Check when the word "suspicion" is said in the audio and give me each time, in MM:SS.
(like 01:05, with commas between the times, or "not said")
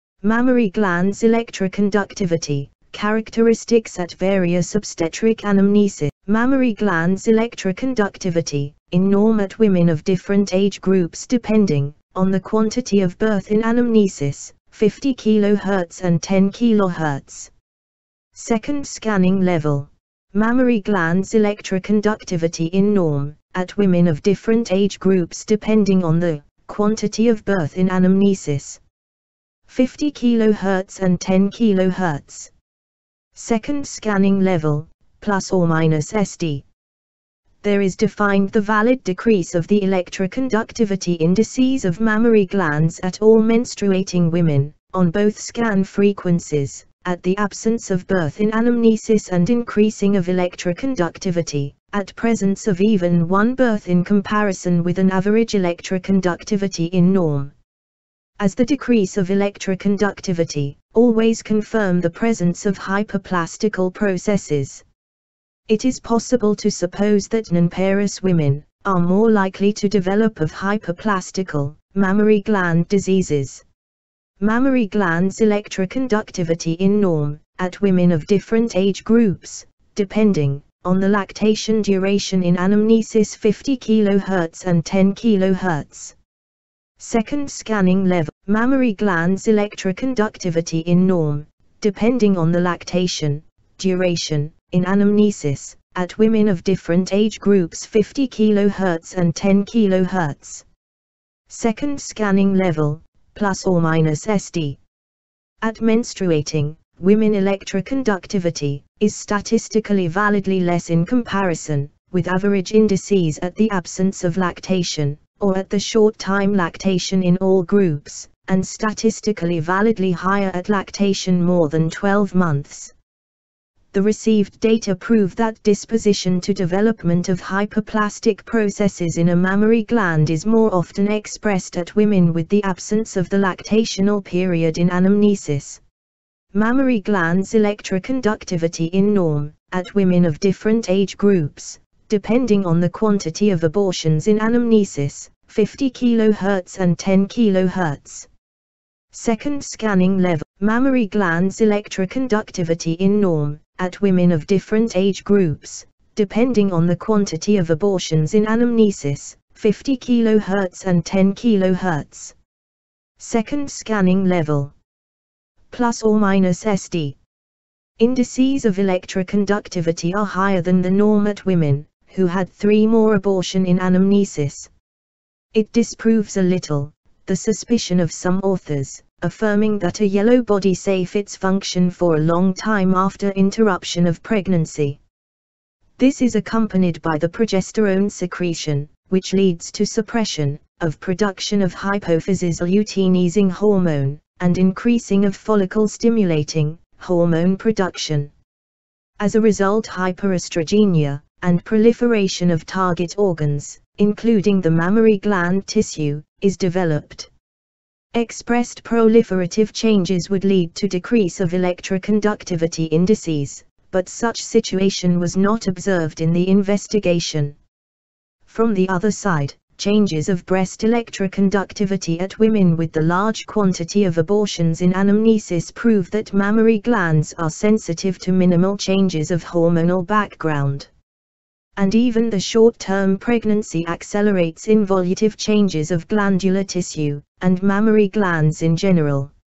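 02:57.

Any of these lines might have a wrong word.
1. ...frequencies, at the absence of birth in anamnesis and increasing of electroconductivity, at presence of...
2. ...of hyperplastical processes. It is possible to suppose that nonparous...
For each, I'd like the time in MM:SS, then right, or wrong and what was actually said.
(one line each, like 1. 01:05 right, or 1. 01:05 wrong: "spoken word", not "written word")
1. 00:45 right
2. 01:02 right.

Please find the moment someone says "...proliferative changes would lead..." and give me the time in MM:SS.
03:28.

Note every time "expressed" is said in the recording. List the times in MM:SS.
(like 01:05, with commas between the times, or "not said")
02:11, 03:28.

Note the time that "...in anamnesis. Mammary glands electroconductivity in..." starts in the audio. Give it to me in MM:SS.
02:14.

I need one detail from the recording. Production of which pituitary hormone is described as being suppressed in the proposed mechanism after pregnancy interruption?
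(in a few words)
luteinizing hormone.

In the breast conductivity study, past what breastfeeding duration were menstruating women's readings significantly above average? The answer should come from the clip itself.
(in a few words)
12 months.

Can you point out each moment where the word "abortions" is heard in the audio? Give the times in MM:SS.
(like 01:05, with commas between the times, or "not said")
02:23, 02:37, 02:53, 03:44.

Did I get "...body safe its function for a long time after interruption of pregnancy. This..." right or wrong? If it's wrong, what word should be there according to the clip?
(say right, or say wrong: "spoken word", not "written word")
right.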